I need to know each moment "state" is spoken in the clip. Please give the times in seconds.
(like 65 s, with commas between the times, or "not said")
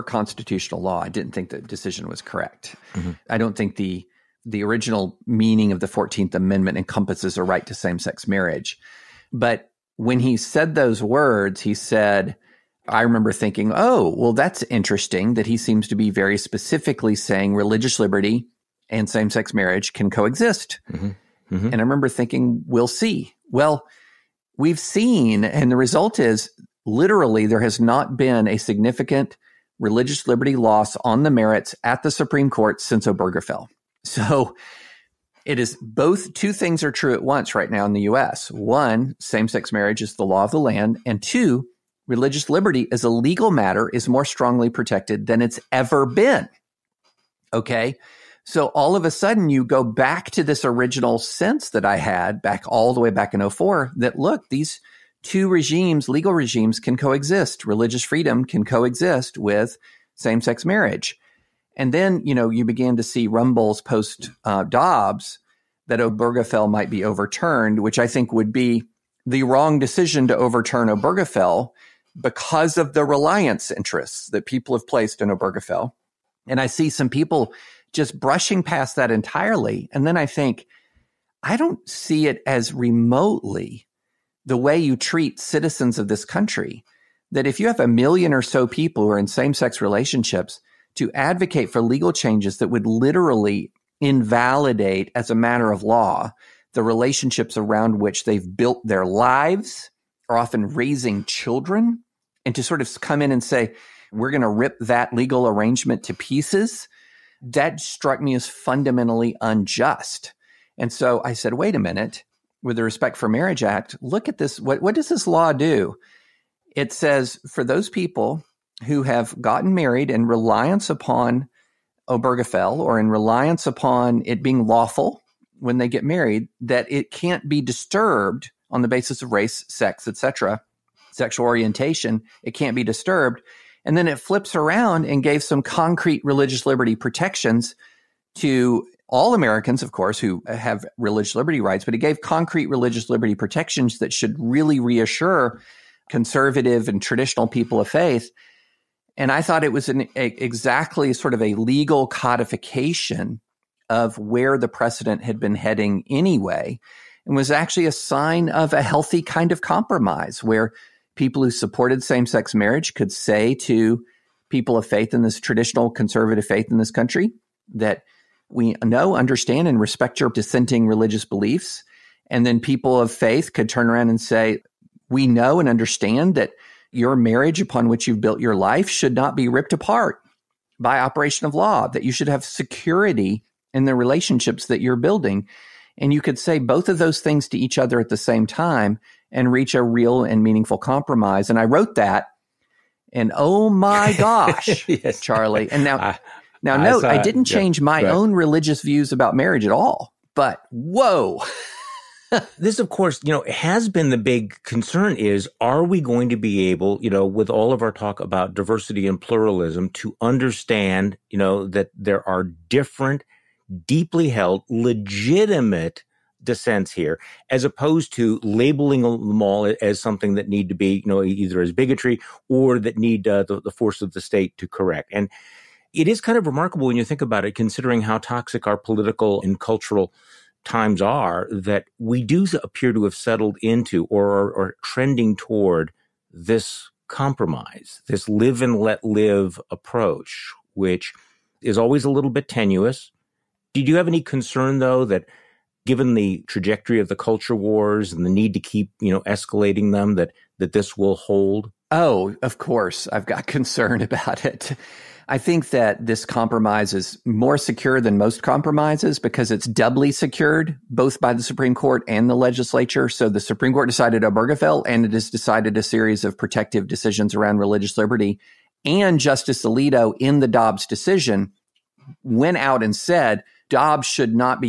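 224 s.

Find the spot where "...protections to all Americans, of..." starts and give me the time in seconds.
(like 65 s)
136 s.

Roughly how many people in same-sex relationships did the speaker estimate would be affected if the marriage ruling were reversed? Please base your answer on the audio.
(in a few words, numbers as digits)
a million.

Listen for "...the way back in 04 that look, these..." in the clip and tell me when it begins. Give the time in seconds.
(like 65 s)
52 s.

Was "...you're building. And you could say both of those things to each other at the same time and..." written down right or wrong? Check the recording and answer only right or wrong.
right.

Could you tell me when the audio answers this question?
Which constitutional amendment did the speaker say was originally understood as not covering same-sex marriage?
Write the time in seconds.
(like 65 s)
5 s.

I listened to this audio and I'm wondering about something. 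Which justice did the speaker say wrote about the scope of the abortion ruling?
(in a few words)
Justice Alito.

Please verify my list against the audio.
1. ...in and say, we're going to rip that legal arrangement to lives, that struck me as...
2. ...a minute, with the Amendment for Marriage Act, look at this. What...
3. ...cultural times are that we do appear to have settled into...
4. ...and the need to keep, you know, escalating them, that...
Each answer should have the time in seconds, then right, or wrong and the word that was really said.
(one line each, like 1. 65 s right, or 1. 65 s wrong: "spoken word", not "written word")
1. 103 s wrong: "pieces", not "lives"
2. 111 s wrong: "Respect", not "Amendment"
3. 229 s right
4. 248 s right.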